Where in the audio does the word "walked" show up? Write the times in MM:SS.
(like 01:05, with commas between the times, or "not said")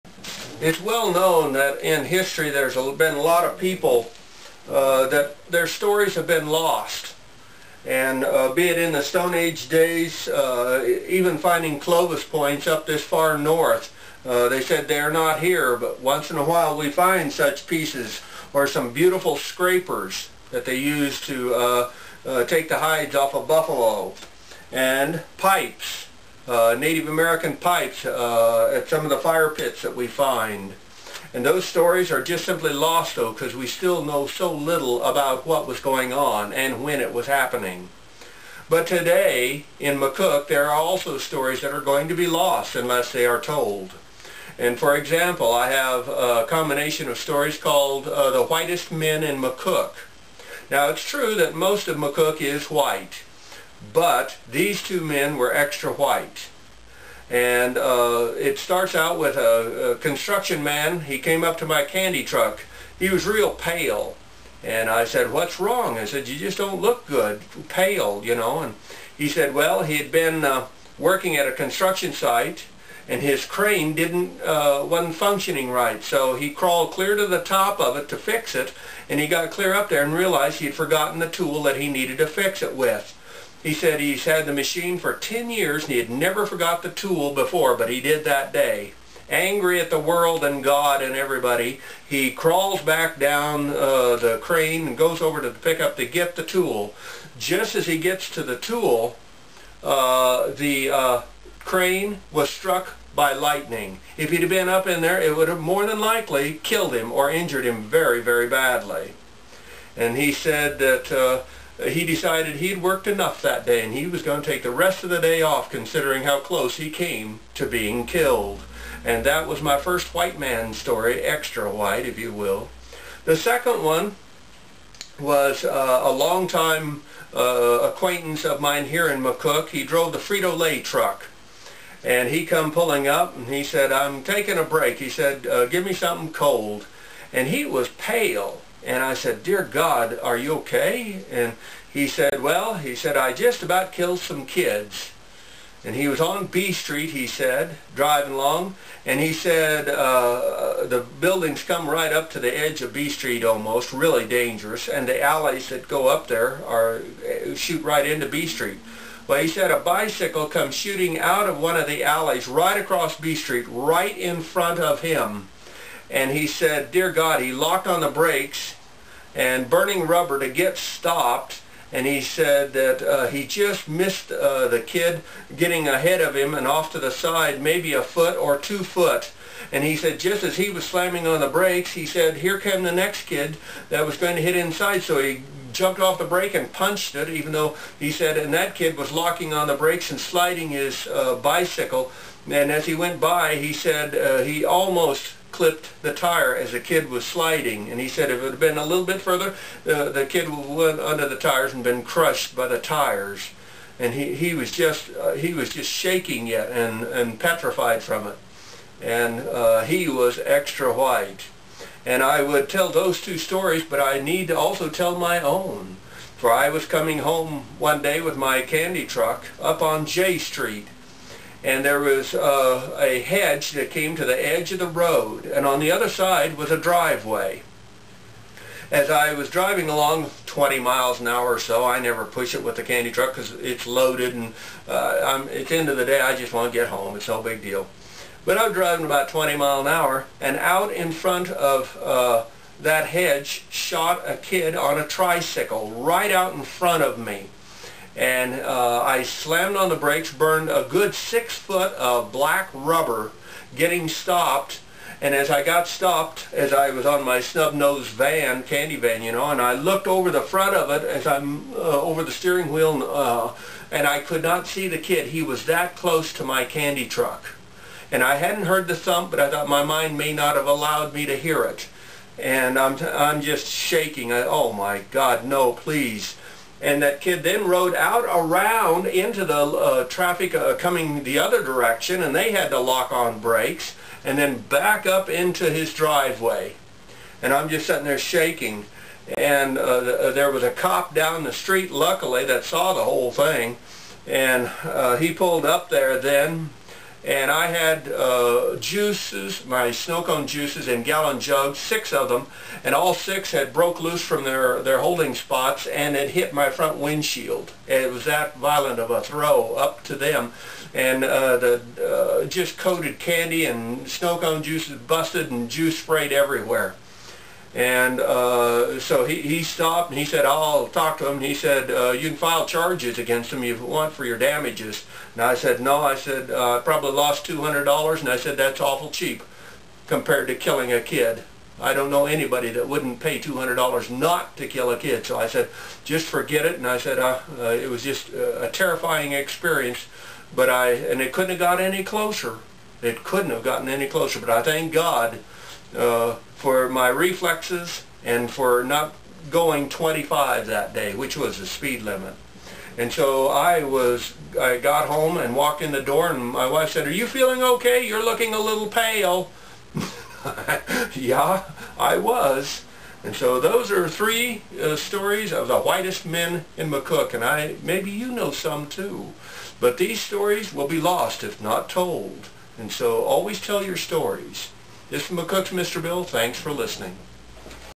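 05:55.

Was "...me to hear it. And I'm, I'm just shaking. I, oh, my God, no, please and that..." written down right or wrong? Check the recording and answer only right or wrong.
right.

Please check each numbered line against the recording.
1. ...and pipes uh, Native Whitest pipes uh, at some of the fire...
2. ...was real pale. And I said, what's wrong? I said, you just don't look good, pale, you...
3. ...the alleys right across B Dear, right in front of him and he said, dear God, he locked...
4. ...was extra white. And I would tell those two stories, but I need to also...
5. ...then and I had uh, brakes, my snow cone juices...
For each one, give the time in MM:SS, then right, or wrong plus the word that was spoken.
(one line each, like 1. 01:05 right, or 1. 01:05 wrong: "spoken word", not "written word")
1. 00:24 wrong: "American", not "Whitest"
2. 01:03 right
3. 02:41 wrong: "Street", not "Dear"
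4. 03:30 right
5. 04:56 wrong: "juices", not "brakes".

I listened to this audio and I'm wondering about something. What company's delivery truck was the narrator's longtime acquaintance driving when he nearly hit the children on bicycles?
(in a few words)
Frito-Lay.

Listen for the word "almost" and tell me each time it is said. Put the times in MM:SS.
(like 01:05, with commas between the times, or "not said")
02:33, 03:14.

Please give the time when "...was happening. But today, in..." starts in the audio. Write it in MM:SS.
00:37.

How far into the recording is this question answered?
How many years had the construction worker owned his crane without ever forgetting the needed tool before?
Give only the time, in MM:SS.
01:25.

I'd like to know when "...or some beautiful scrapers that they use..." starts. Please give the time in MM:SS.
00:18.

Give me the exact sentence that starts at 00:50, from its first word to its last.
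Now, it's true that most of McCook is white.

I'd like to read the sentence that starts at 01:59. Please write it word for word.
And that was my first white man story, extra white if you will.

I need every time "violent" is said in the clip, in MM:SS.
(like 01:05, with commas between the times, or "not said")
05:08.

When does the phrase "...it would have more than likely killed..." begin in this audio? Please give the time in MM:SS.
01:45.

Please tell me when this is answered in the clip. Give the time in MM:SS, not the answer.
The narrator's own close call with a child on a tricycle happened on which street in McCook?
03:40.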